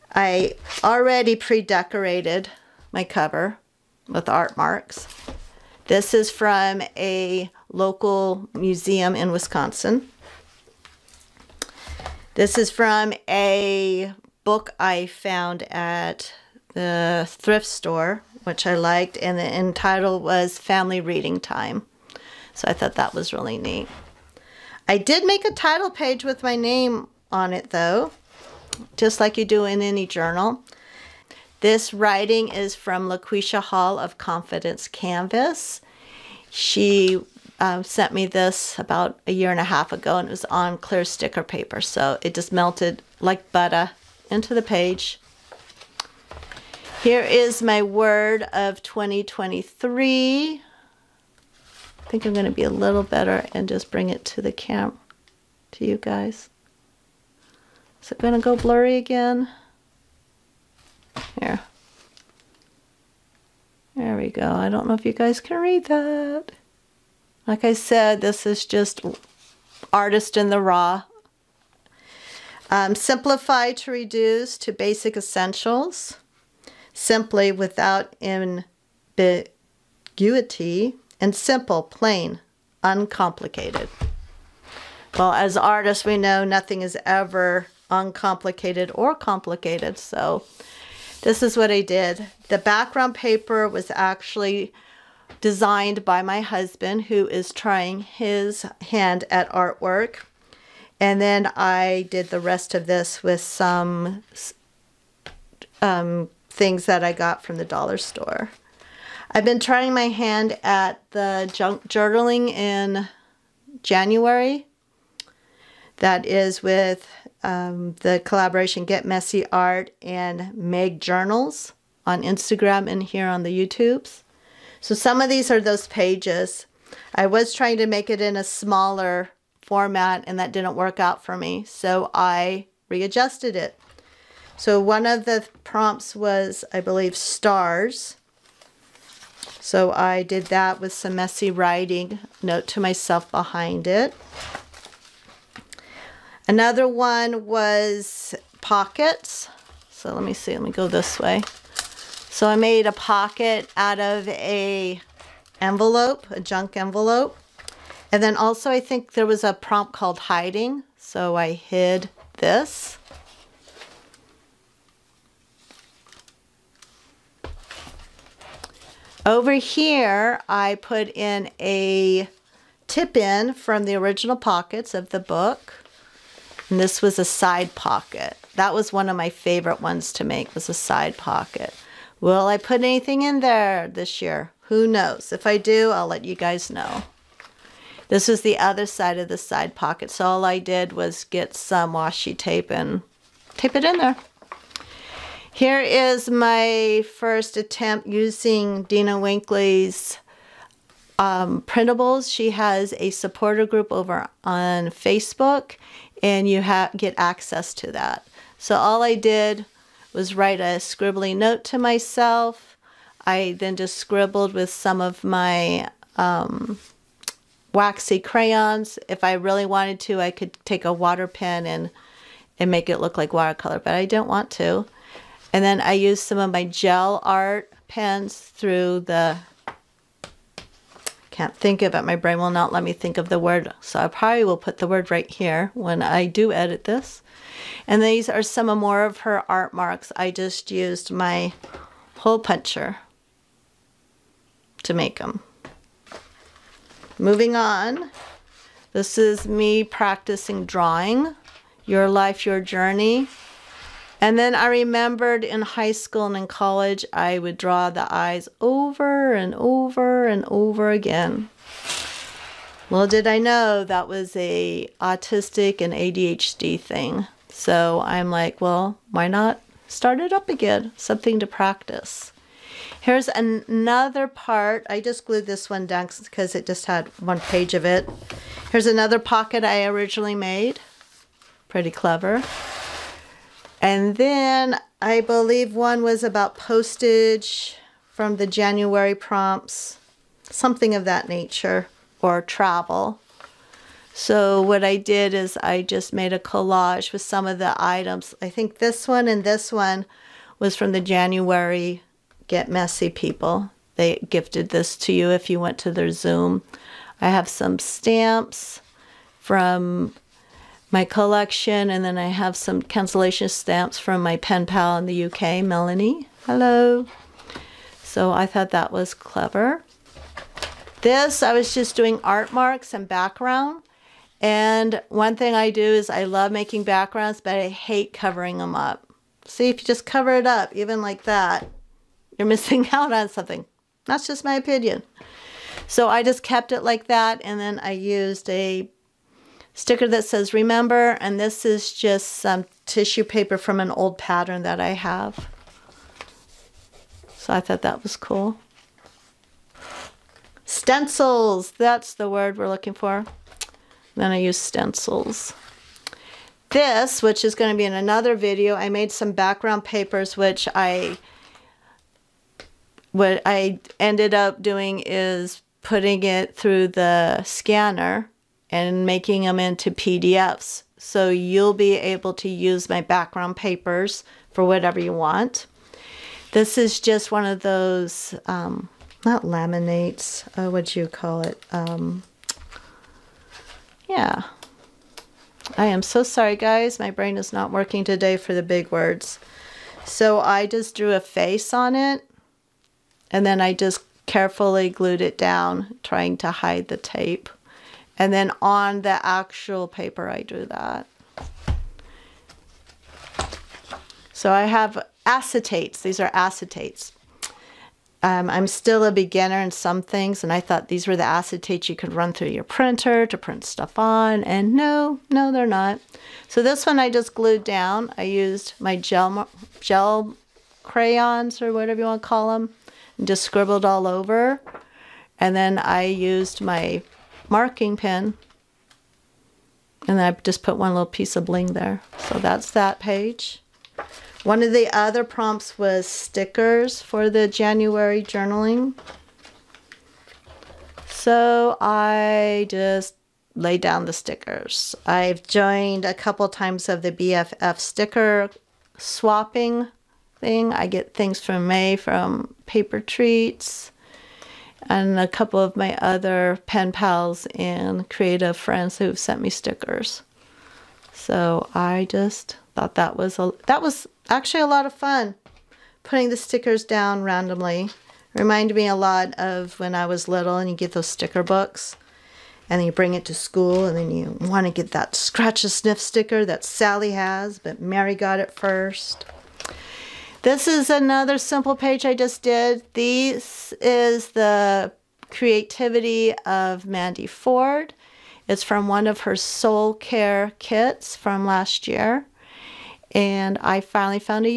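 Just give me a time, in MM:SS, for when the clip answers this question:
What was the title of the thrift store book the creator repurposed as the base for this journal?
00:20.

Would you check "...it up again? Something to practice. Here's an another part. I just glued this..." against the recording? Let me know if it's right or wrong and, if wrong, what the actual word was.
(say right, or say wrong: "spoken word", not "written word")
right.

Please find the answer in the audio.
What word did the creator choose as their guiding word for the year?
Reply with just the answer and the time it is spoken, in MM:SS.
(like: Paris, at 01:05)
simplify, at 01:12.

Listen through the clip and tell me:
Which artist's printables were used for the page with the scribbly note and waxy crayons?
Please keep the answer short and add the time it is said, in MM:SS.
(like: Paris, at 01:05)
Dina Wakley, at 03:18.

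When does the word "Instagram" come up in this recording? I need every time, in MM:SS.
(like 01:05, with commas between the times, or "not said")
02:02.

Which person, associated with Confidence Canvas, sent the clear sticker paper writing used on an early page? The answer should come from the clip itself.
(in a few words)
LaQuisha Hall.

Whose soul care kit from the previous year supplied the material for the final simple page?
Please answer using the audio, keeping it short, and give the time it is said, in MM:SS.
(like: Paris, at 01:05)
Mandy Ford, at 08:06.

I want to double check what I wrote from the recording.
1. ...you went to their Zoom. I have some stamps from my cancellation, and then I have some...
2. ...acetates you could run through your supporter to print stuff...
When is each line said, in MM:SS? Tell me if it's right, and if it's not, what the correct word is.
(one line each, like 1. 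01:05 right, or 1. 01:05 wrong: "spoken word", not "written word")
1. 05:05 wrong: "collection", not "cancellation"
2. 06:51 wrong: "printer", not "supporter".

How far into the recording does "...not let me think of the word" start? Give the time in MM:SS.
03:52.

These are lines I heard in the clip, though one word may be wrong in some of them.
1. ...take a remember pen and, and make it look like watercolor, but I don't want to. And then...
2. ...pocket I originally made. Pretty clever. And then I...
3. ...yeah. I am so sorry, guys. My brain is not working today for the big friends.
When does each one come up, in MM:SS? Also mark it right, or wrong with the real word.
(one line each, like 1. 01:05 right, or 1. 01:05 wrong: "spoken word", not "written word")
1. 03:40 wrong: "water", not "remember"
2. 04:39 right
3. 06:24 wrong: "words", not "friends".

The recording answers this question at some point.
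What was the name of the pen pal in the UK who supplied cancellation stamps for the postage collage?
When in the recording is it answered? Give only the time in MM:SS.
05:15.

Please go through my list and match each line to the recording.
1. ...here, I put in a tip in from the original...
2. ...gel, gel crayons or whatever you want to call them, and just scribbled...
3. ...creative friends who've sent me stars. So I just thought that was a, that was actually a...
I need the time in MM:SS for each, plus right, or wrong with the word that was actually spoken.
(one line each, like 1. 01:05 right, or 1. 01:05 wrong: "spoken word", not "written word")
1. 02:49 right
2. 06:58 right
3. 07:38 wrong: "stickers", not "stars".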